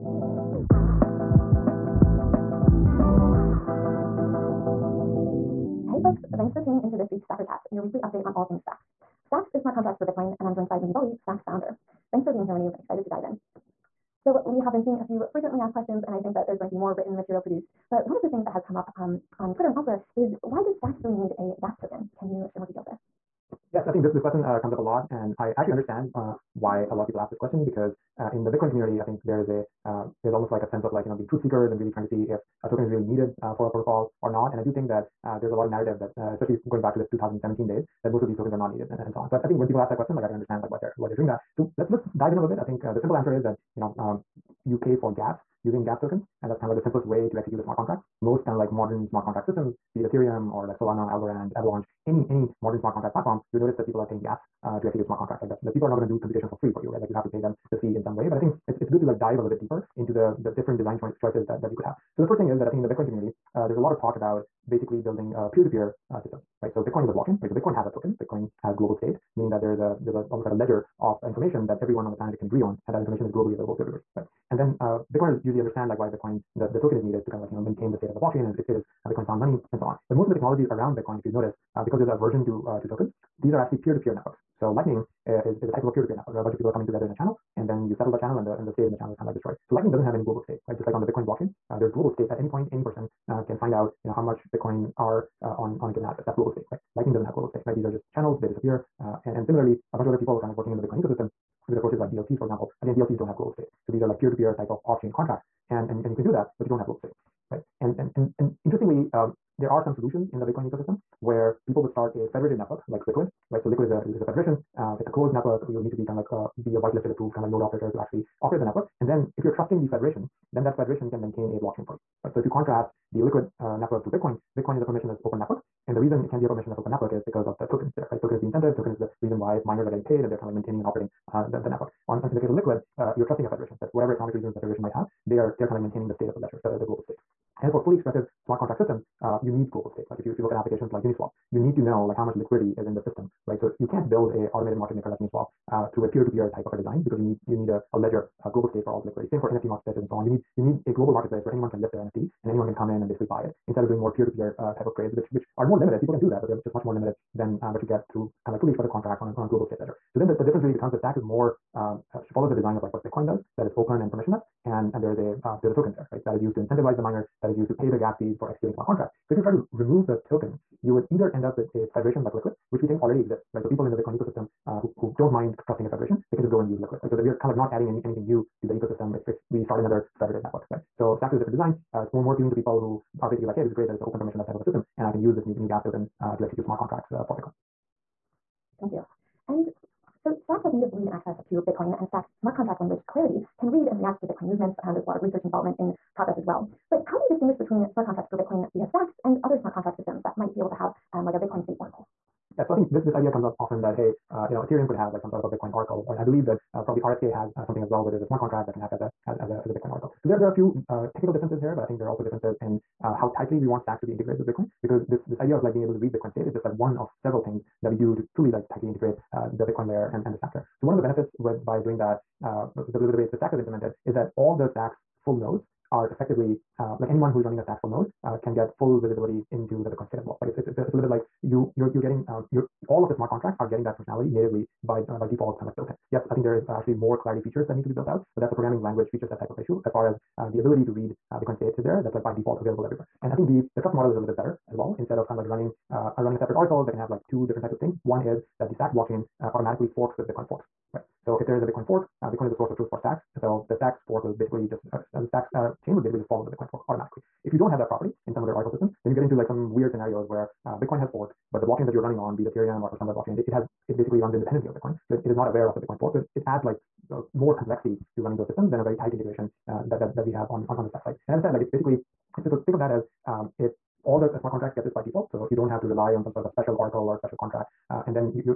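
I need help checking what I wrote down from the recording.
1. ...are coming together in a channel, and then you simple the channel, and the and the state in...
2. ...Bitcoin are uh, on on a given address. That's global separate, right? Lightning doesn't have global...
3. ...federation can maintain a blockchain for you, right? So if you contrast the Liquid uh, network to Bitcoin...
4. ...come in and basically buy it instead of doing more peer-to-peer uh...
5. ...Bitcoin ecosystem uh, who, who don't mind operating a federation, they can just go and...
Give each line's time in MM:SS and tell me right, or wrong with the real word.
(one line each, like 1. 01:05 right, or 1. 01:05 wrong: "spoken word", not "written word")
1. 01:26 wrong: "settle", not "simple"
2. 01:34 wrong: "state", not "separate"
3. 02:00 right
4. 02:32 right
5. 02:53 wrong: "trusting", not "operating".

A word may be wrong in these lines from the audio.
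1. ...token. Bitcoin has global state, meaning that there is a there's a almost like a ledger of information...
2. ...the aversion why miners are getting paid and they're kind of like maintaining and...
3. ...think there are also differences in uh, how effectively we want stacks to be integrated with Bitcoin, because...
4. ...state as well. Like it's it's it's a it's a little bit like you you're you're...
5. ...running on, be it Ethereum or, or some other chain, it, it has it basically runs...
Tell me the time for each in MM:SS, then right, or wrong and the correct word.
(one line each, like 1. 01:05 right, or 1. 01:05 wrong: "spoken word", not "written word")
1. 01:07 right
2. 02:08 wrong: "reason", not "aversion"
3. 03:31 wrong: "tightly", not "effectively"
4. 03:50 right
5. 04:22 wrong: "blockchain", not "chain".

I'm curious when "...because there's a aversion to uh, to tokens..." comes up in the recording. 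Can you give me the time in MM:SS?
01:21.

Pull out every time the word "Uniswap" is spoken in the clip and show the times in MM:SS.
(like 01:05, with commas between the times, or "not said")
02:21, 02:25.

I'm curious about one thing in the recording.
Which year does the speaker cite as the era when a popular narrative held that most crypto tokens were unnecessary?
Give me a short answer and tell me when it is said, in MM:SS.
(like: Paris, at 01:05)
2017, at 00:37.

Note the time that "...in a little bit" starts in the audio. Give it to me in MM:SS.
00:42.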